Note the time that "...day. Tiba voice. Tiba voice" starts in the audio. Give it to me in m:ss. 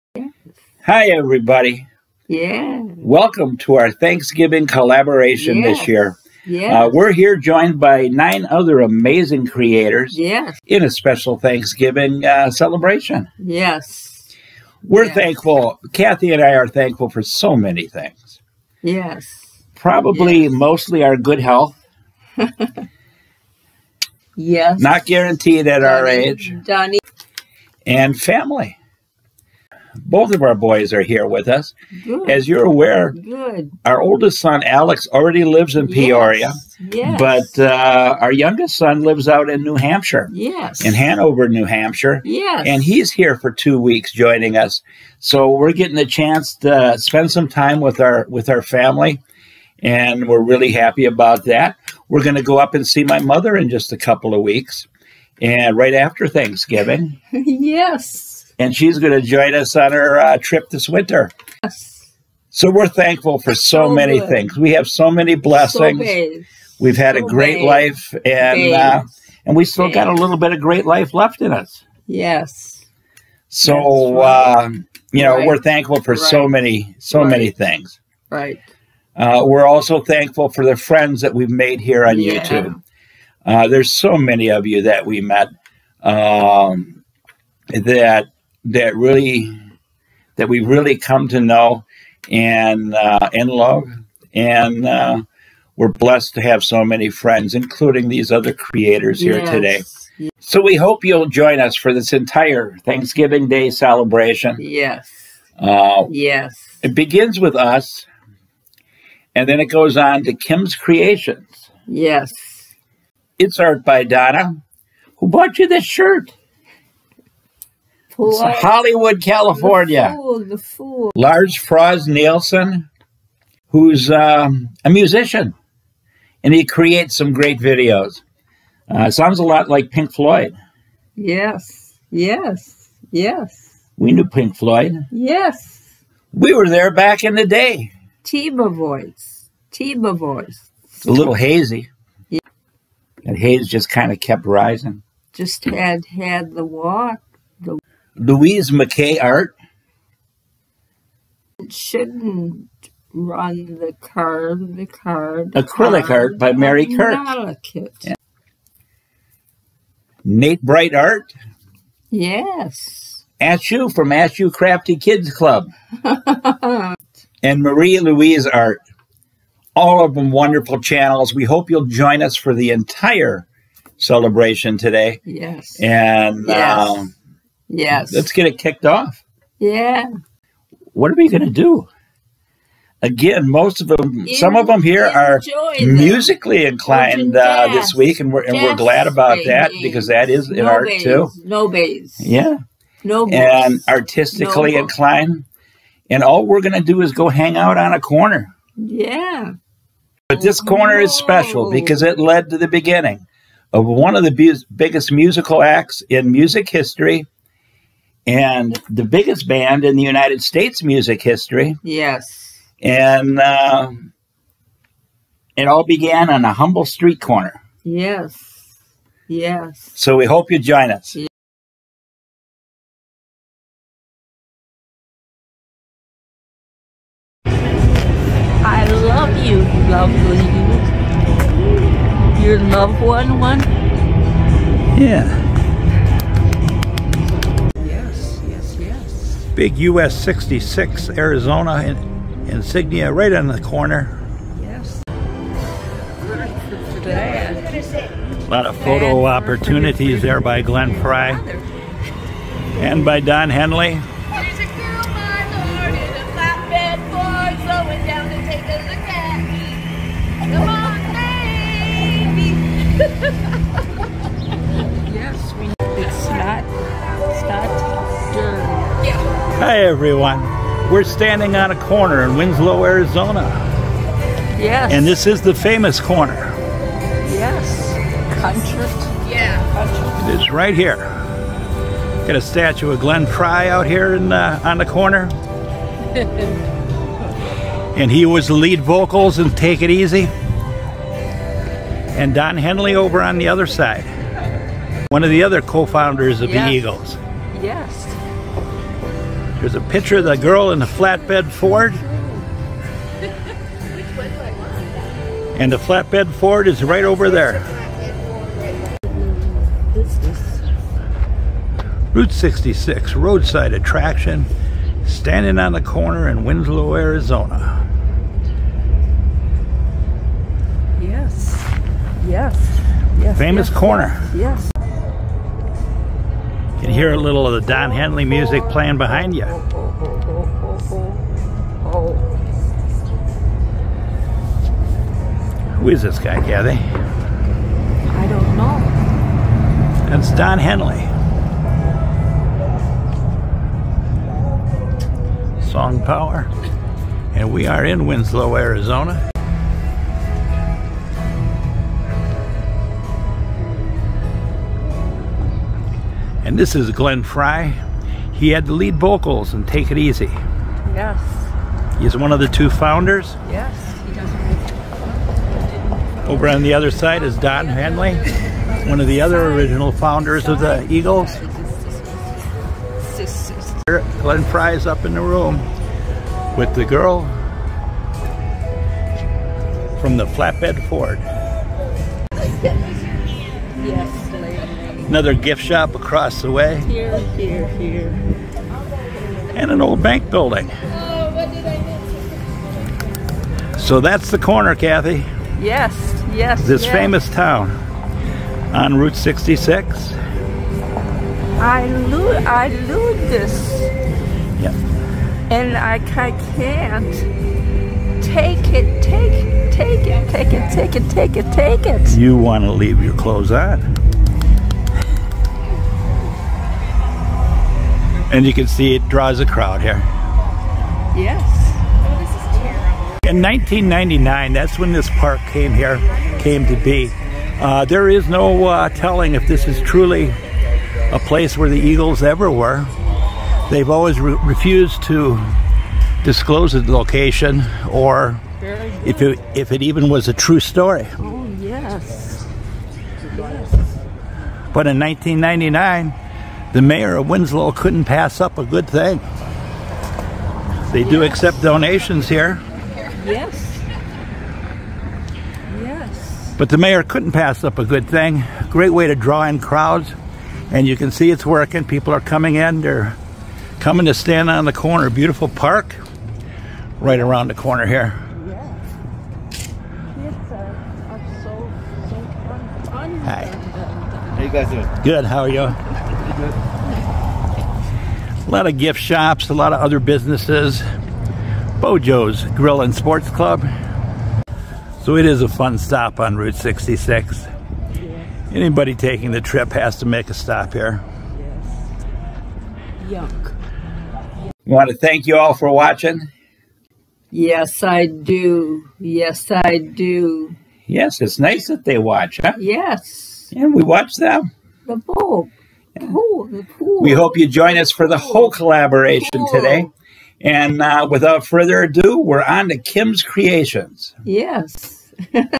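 2:17.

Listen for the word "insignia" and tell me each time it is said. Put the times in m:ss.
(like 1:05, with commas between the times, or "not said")
4:02.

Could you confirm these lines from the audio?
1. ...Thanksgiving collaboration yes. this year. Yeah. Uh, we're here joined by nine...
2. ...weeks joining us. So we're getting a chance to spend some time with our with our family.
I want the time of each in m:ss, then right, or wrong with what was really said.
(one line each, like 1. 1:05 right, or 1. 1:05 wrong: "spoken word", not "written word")
1. 0:03 right
2. 0:43 right.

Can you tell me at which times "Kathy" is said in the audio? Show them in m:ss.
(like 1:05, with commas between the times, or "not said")
0:15, 5:36, 6:34.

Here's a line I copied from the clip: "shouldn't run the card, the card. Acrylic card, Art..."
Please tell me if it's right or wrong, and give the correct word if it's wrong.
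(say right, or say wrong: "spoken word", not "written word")
right.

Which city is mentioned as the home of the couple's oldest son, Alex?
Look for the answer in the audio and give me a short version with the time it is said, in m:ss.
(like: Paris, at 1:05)
Peoria, at 0:35.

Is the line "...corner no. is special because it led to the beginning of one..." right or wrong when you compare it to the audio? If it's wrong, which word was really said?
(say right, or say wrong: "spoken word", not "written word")
right.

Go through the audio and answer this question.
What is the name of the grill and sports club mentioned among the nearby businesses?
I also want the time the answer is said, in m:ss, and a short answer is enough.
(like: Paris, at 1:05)
Bojo's Grill, at 8:01.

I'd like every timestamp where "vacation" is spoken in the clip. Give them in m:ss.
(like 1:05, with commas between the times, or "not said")
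not said.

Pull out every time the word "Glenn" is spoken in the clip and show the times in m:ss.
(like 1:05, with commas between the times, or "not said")
4:10, 4:42, 5:56, 6:14.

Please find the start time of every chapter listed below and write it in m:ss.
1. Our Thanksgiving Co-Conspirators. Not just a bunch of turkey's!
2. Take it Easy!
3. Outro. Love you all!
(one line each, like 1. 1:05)
1. 1:47
2. 3:40
3. 8:13.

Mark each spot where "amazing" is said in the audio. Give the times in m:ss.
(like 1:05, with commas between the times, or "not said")
0:08.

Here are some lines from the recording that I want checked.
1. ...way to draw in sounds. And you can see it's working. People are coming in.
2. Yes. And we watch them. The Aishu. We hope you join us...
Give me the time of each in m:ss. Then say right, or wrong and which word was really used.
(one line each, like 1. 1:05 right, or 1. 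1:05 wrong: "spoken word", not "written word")
1. 7:38 wrong: "crowds", not "sounds"
2. 8:22 wrong: "Bulb", not "Aishu".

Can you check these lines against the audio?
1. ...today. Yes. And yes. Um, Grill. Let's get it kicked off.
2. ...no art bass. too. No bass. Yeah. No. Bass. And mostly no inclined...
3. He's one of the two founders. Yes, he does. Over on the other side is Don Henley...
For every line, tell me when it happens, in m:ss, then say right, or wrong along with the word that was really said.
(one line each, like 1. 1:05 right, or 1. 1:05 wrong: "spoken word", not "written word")
1. 2:54 wrong: "Yes", not "Grill"
2. 3:10 wrong: "artistically", not "mostly"
3. 6:02 right.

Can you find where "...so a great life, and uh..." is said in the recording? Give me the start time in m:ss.
1:07.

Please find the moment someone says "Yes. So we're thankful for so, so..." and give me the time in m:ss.
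1:01.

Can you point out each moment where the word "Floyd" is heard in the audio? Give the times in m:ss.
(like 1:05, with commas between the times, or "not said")
2:10, 2:14.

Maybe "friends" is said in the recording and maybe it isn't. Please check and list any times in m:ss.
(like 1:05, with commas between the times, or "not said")
1:20, 1:37.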